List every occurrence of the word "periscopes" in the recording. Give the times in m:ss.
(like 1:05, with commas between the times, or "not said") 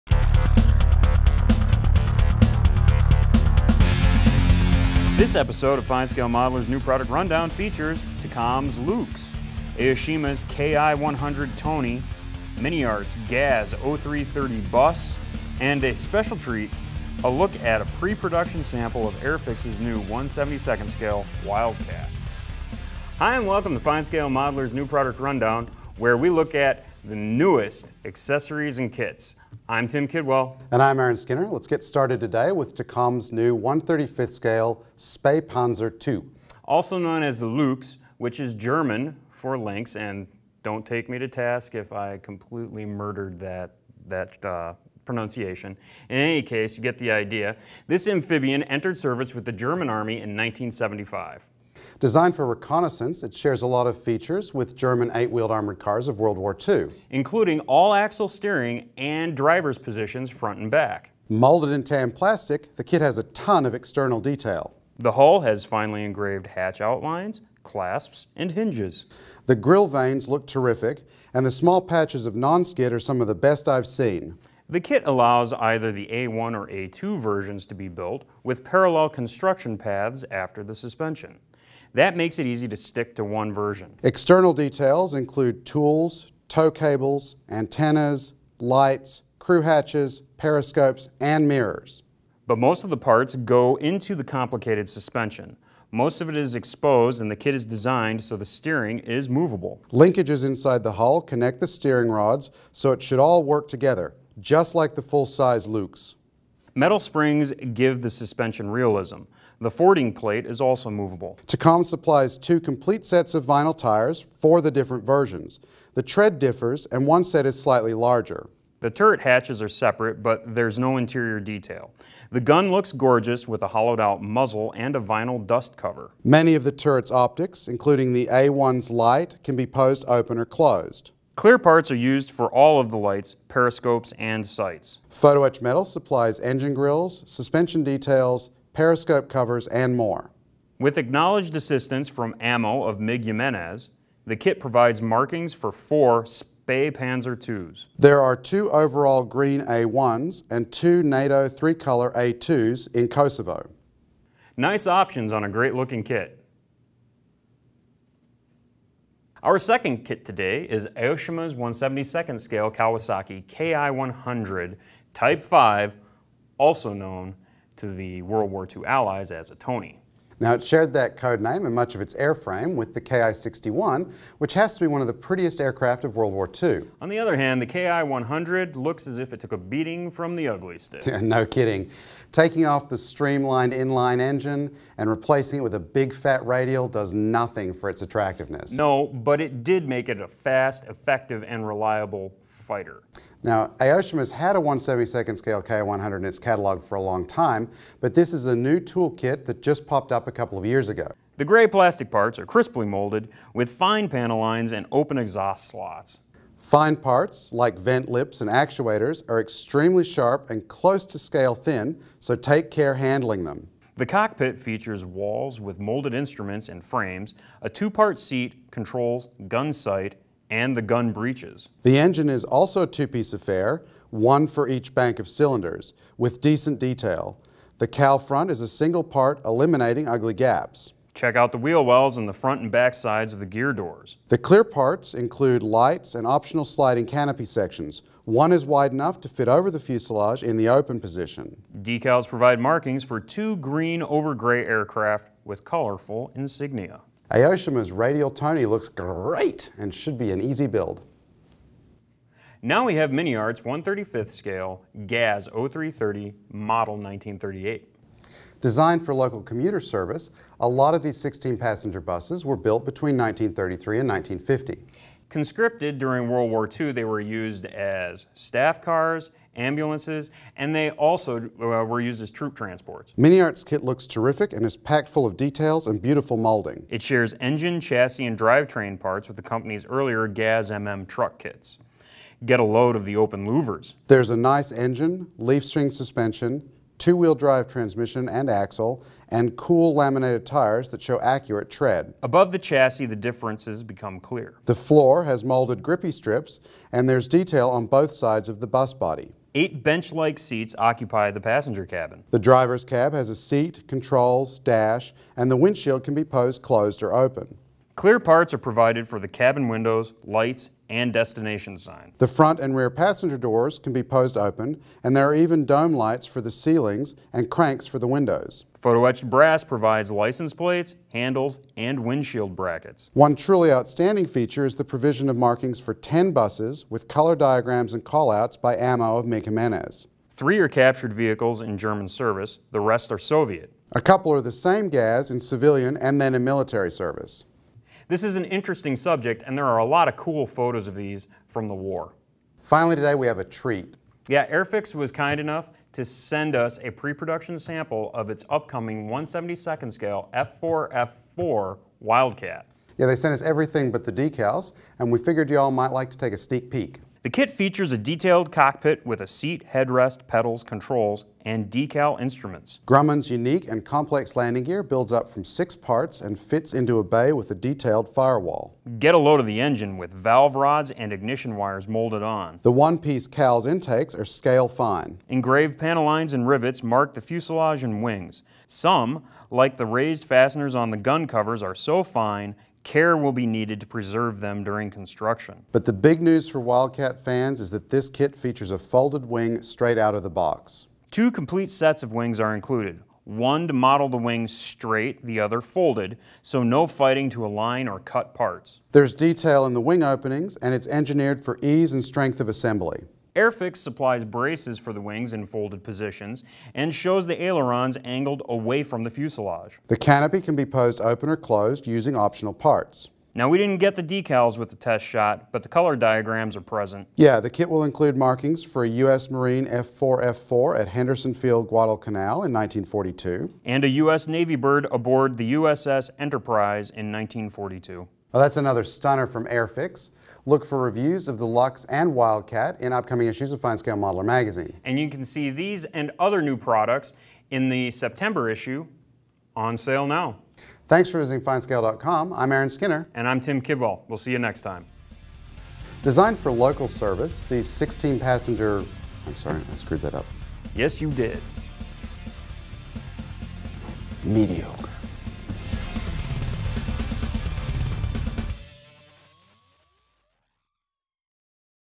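1:30, 2:13, 2:18.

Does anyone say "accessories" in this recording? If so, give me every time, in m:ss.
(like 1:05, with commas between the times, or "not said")
0:28.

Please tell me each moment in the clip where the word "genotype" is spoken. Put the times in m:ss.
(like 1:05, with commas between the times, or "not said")
not said.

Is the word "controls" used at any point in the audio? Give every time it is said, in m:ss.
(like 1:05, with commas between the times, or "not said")
3:38, 5:03, 6:00.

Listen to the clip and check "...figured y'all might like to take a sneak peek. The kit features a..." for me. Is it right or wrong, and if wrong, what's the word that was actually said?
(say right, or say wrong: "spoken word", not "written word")
right.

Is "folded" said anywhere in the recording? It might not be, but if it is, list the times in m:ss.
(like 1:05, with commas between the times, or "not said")
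6:28, 6:35, 6:45.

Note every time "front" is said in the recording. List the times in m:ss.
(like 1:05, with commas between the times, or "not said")
1:00, 3:48, 3:52, 5:12.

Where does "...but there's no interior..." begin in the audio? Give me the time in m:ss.
2:00.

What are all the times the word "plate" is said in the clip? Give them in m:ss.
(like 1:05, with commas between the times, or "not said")
1:50, 5:20.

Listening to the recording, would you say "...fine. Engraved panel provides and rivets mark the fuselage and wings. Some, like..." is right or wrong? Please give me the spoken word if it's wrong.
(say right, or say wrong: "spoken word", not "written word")
wrong: "lines", not "provides".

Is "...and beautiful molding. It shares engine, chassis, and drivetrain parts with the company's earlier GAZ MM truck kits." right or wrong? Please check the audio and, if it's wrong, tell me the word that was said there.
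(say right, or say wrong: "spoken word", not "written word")
right.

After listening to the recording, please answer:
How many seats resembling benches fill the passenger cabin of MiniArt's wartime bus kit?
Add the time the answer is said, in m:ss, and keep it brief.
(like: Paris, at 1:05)
Eight, at 4:59.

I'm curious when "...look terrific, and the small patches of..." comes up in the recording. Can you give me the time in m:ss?
1:10.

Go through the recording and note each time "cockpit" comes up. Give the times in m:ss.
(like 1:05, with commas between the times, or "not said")
3:34, 5:58.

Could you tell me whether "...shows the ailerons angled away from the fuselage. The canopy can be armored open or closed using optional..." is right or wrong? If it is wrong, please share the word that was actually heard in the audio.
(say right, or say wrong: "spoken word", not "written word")
wrong: "posed", not "armored".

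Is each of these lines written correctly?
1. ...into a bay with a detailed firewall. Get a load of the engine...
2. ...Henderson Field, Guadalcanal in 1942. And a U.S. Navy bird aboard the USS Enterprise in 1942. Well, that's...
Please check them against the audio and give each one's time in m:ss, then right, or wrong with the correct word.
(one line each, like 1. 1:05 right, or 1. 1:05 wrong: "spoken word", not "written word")
1. 6:06 right
2. 7:00 right.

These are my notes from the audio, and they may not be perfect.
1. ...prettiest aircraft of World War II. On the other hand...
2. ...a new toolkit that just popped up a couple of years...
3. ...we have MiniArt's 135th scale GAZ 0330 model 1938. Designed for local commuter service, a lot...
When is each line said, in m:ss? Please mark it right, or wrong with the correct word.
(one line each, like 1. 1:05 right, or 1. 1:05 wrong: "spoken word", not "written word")
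1. 2:55 right
2. 3:18 right
3. 4:12 right.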